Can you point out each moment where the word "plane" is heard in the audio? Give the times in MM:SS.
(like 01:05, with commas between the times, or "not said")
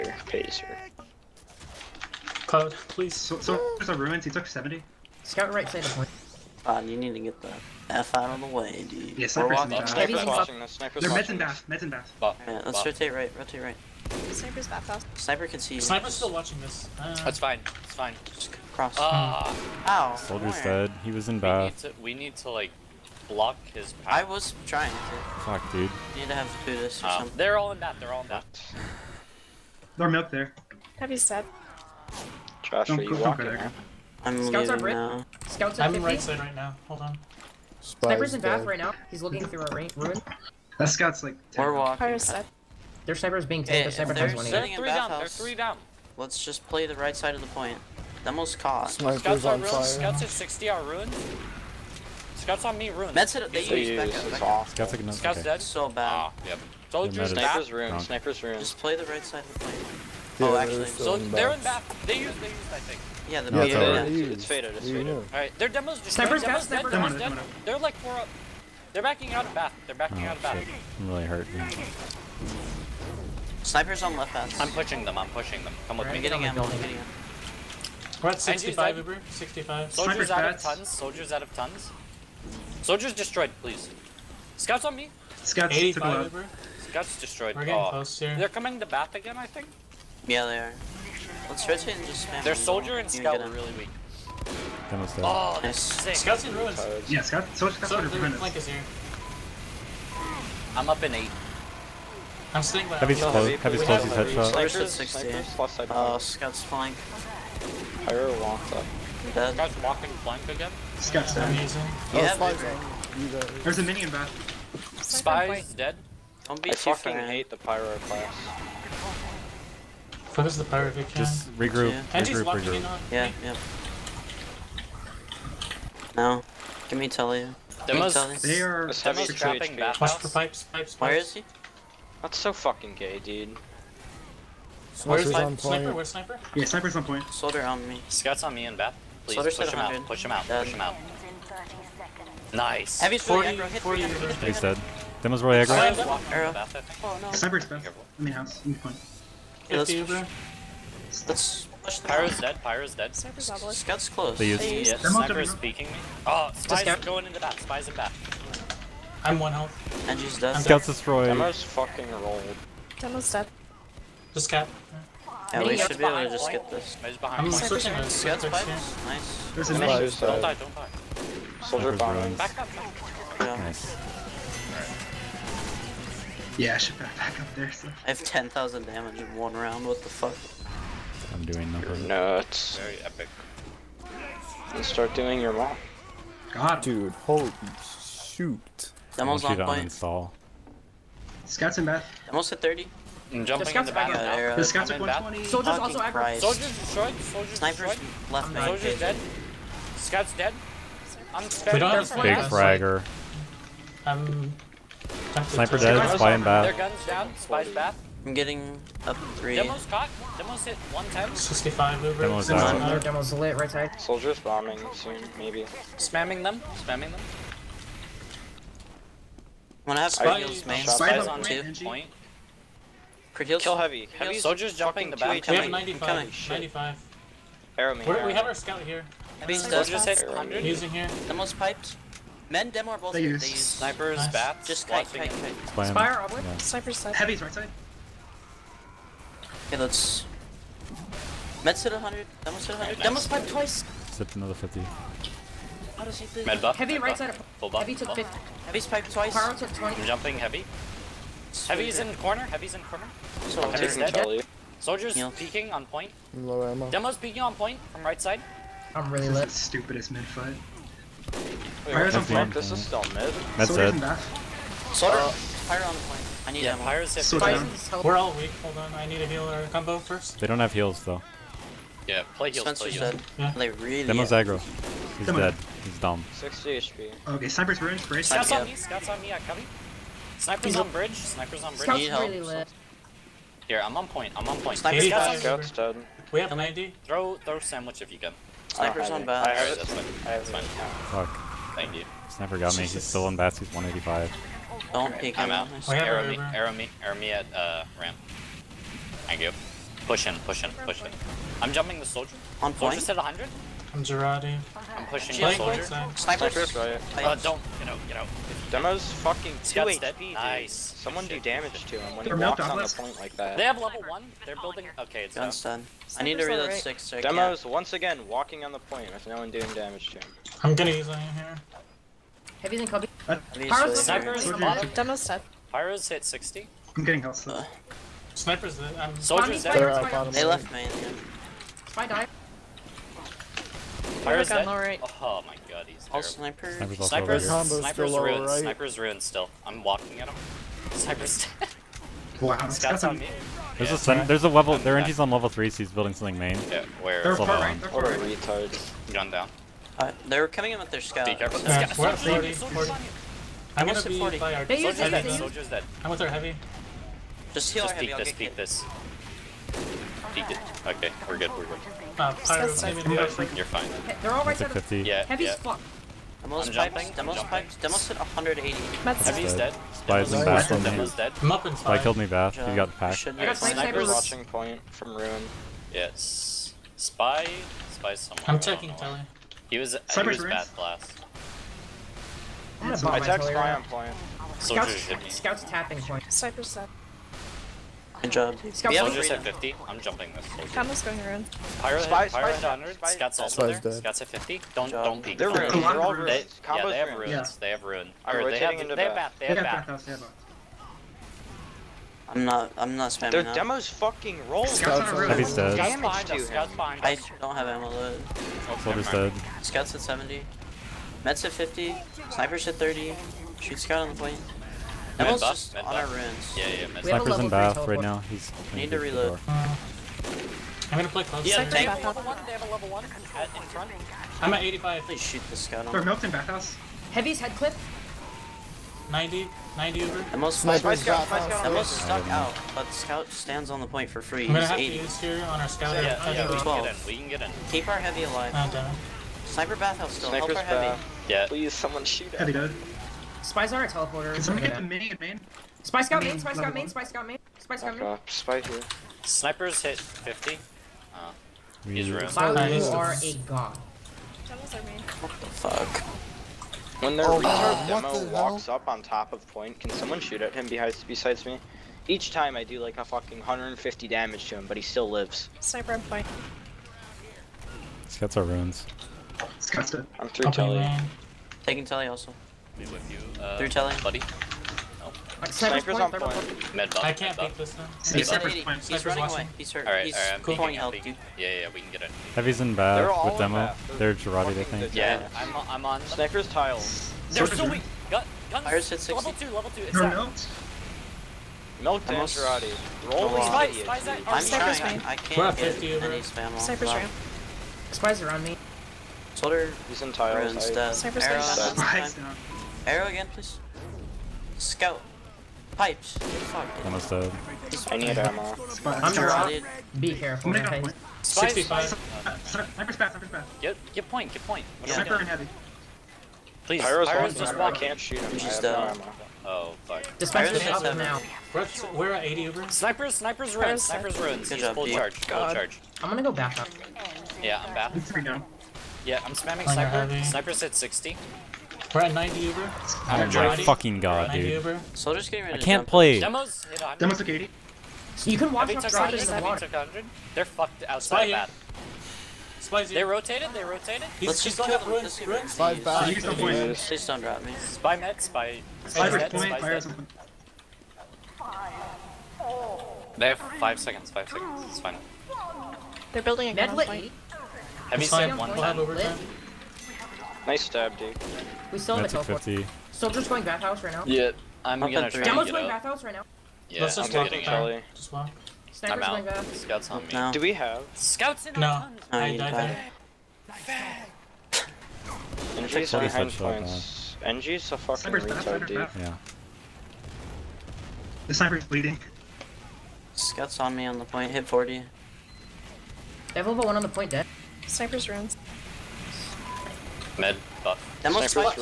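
00:59, 06:54.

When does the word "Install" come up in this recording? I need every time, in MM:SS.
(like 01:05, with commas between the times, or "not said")
03:09.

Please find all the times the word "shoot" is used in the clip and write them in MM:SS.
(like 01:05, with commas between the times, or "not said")
03:08, 06:53, 07:05, 07:22, 07:40, 08:37.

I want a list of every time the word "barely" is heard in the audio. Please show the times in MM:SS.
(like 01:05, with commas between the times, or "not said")
not said.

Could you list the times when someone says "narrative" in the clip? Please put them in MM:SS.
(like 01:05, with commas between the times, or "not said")
not said.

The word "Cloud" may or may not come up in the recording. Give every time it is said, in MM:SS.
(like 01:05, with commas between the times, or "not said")
00:02, 07:32.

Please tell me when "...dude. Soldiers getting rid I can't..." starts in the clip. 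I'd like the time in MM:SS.
08:54.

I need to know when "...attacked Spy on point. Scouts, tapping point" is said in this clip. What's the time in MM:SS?
06:23.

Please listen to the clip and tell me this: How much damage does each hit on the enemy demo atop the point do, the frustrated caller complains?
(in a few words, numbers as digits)
150.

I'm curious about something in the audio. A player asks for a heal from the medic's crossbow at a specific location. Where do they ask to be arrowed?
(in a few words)
ramp.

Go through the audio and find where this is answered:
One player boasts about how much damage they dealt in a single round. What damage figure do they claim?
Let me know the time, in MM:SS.
02:58.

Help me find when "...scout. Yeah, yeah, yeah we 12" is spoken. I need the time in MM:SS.
07:15.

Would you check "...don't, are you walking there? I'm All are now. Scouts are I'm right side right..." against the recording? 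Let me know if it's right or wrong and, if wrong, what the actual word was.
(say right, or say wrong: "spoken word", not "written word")
wrong: "Scouts", not "All".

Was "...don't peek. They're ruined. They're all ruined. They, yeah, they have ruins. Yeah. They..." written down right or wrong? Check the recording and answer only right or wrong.
right.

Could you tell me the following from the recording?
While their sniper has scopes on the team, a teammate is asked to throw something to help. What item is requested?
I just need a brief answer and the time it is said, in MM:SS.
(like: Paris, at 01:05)
sandwich, at 04:47.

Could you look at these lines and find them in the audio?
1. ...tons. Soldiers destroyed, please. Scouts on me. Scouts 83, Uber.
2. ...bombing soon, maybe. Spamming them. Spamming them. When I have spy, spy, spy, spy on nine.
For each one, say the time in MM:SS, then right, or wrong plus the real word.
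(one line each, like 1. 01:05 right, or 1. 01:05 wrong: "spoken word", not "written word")
1. 01:21 wrong: "85", not "83"
2. 03:34 wrong: "two", not "nine".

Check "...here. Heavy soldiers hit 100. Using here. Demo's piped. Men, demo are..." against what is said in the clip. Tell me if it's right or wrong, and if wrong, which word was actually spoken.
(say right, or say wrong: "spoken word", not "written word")
right.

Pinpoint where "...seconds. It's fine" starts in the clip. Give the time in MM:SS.
09:14.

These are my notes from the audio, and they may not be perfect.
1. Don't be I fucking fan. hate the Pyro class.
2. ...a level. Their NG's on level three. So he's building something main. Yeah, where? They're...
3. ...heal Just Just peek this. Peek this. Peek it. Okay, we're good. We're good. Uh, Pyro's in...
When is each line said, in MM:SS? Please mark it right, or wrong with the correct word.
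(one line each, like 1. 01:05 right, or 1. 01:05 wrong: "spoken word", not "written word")
1. 01:56 right
2. 05:44 right
3. 05:57 right.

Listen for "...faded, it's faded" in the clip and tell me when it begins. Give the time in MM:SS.
01:04.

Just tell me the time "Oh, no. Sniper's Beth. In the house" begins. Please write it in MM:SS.
02:27.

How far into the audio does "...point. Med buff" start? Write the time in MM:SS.
07:56.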